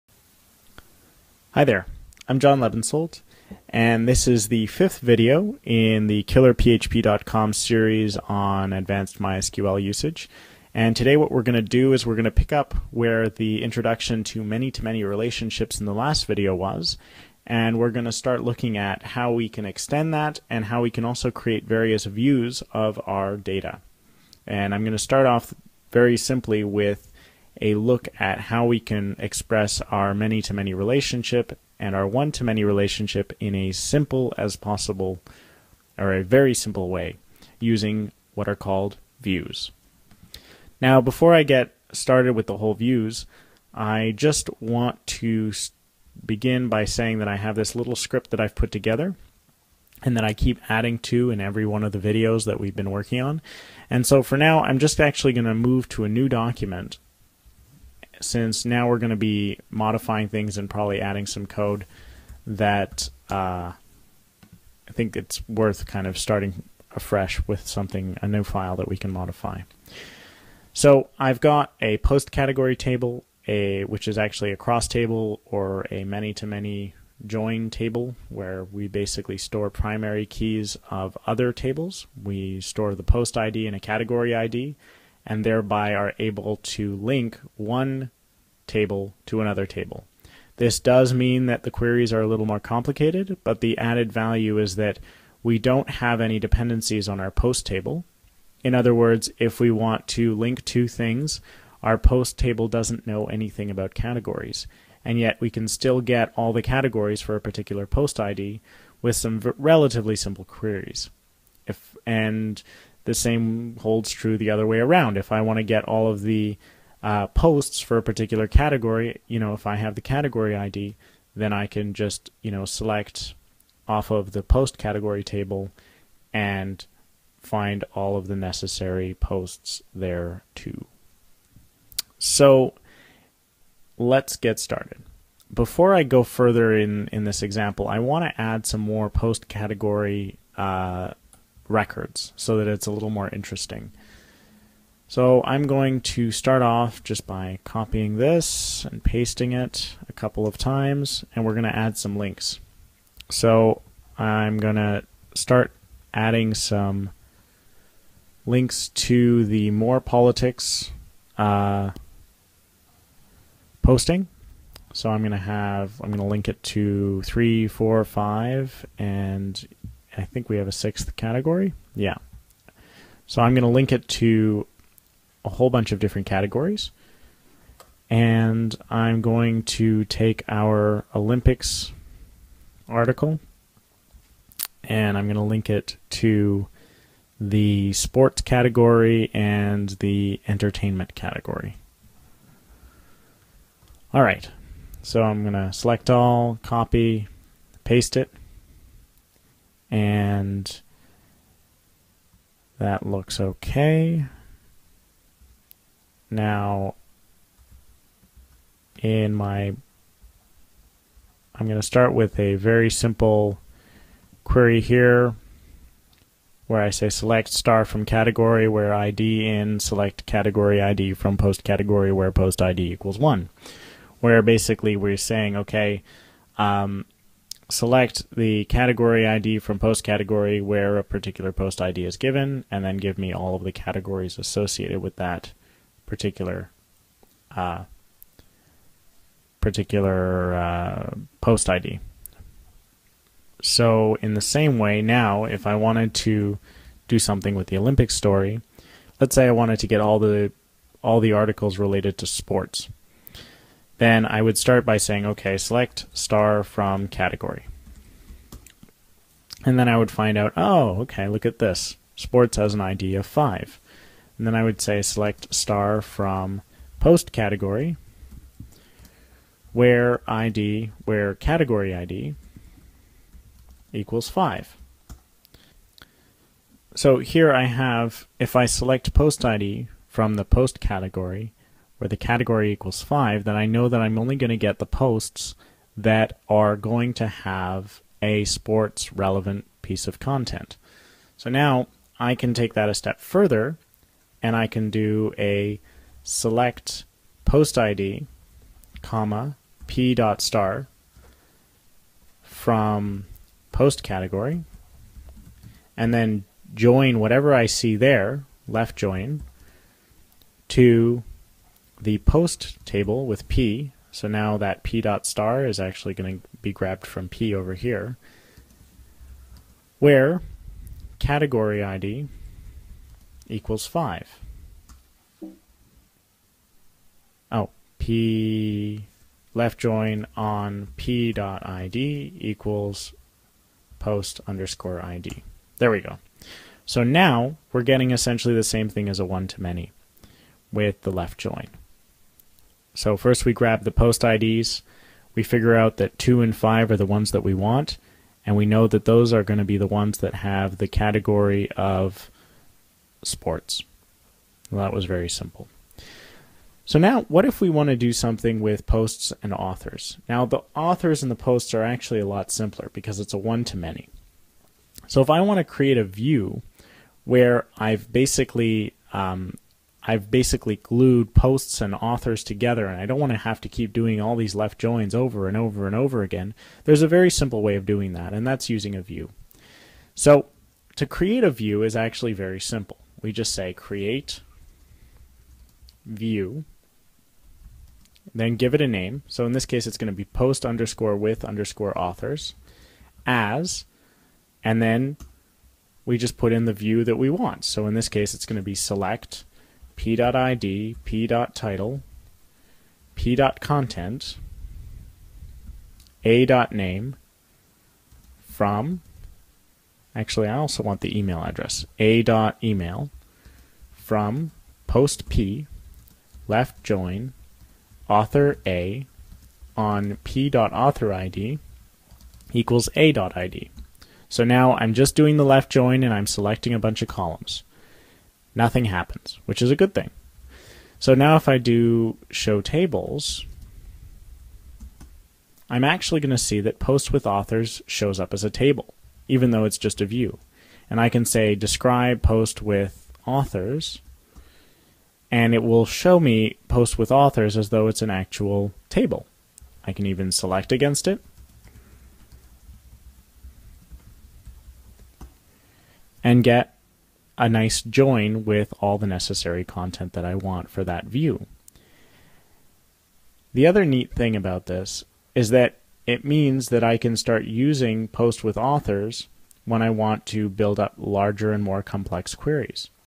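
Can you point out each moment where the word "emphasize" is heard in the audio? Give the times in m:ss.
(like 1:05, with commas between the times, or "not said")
not said.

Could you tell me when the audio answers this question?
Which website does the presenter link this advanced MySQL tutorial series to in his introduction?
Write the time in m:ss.
0:06.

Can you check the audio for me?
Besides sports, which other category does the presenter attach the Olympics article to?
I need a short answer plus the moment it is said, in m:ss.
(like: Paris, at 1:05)
entertainment, at 3:10.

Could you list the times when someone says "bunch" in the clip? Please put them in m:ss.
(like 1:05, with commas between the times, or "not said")
2:55, 7:06.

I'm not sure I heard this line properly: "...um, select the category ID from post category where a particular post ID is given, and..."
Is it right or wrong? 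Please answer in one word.
right.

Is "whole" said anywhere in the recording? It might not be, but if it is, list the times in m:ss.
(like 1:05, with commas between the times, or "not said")
0:42, 2:55.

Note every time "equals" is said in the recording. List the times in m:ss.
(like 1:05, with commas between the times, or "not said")
3:42, 4:33, 4:42, 5:23, 5:32, 7:02.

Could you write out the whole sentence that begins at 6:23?
We just say create view, then give it a name.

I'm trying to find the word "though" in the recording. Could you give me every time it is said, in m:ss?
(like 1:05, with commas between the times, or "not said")
7:19, 7:27.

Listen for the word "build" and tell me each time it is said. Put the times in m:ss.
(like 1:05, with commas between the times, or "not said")
7:50.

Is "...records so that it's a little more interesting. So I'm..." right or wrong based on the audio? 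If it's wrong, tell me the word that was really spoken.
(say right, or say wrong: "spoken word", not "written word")
right.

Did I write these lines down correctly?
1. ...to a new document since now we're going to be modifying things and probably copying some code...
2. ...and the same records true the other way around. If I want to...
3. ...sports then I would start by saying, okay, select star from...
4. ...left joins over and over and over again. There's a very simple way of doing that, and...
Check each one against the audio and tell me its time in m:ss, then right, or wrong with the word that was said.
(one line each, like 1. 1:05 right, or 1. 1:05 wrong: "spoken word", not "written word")
1. 0:55 wrong: "adding", not "copying"
2. 1:52 wrong: "holds", not "records"
3. 4:12 right
4. 6:14 right.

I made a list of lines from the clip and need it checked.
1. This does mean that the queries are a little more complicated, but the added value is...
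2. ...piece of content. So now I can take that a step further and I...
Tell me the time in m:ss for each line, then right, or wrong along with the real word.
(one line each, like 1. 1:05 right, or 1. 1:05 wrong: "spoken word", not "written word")
1. 1:30 right
2. 4:49 right.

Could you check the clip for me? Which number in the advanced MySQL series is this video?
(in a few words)
fifth.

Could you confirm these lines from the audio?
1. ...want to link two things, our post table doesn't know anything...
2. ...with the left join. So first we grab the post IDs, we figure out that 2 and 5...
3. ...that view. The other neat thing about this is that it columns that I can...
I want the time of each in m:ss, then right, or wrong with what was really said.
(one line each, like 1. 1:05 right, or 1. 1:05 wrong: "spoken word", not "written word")
1. 1:39 right
2. 5:40 right
3. 7:40 wrong: "means", not "columns".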